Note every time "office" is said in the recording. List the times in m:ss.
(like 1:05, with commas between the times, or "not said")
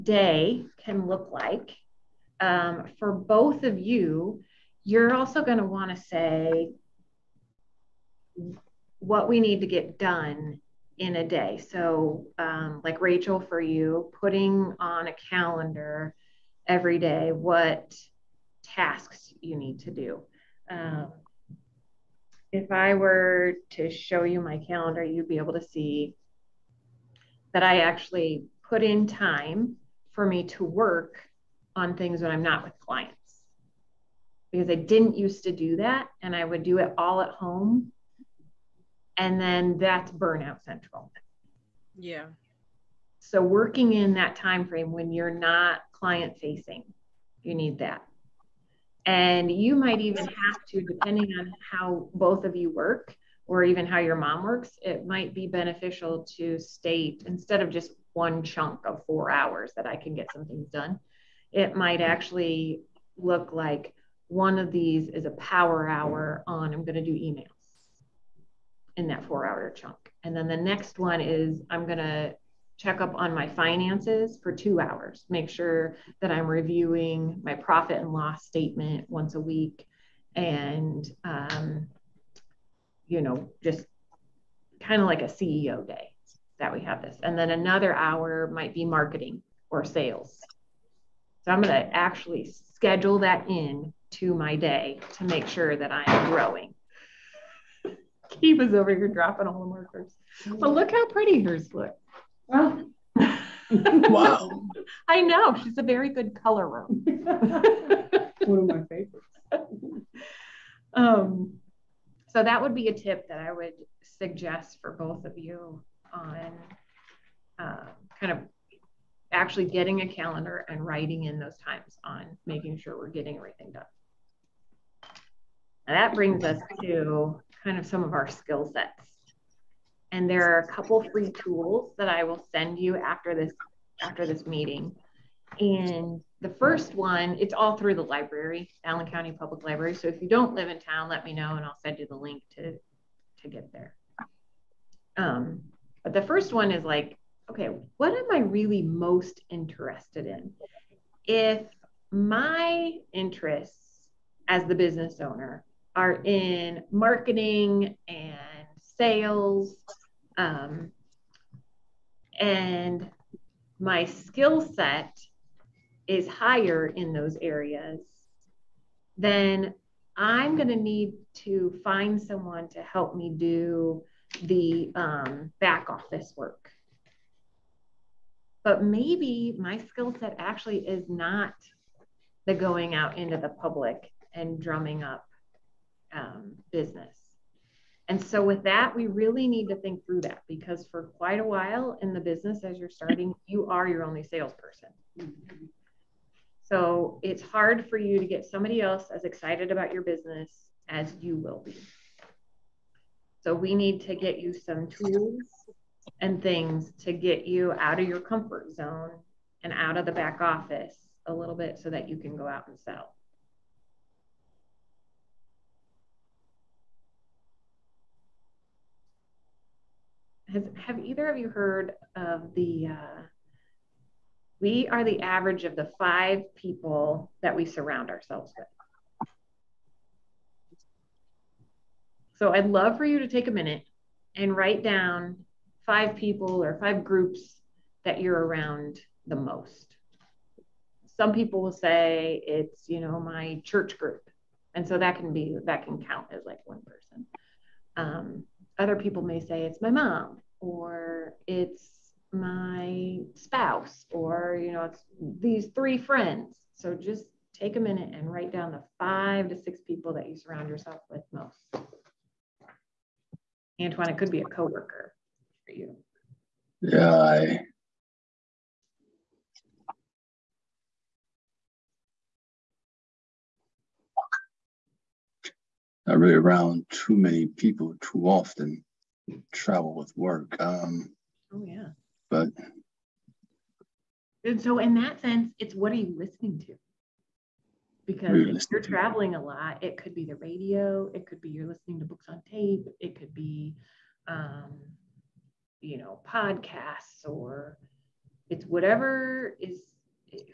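2:55, 3:30.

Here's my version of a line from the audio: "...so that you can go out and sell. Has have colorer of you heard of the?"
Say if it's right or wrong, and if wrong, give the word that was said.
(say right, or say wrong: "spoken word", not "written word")
wrong: "either", not "colorer".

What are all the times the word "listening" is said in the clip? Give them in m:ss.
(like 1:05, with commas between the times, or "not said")
4:46, 4:51.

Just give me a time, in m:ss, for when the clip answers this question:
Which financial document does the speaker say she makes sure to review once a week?
1:17.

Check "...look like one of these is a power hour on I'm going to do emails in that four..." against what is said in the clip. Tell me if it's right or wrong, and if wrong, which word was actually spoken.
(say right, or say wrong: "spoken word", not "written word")
right.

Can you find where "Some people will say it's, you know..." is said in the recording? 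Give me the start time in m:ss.
4:01.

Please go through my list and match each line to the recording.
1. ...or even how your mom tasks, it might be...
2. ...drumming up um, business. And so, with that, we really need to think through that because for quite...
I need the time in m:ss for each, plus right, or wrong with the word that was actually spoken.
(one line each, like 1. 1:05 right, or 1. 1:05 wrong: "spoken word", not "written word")
1. 0:53 wrong: "works", not "tasks"
2. 3:04 right.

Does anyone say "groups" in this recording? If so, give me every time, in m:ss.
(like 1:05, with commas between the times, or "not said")
3:57, 4:03.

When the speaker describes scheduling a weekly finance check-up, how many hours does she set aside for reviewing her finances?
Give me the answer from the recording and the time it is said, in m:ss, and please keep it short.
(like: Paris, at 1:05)
2, at 1:14.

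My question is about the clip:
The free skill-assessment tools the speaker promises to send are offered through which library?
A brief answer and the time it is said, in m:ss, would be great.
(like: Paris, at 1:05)
Allen County Public Library, at 2:18.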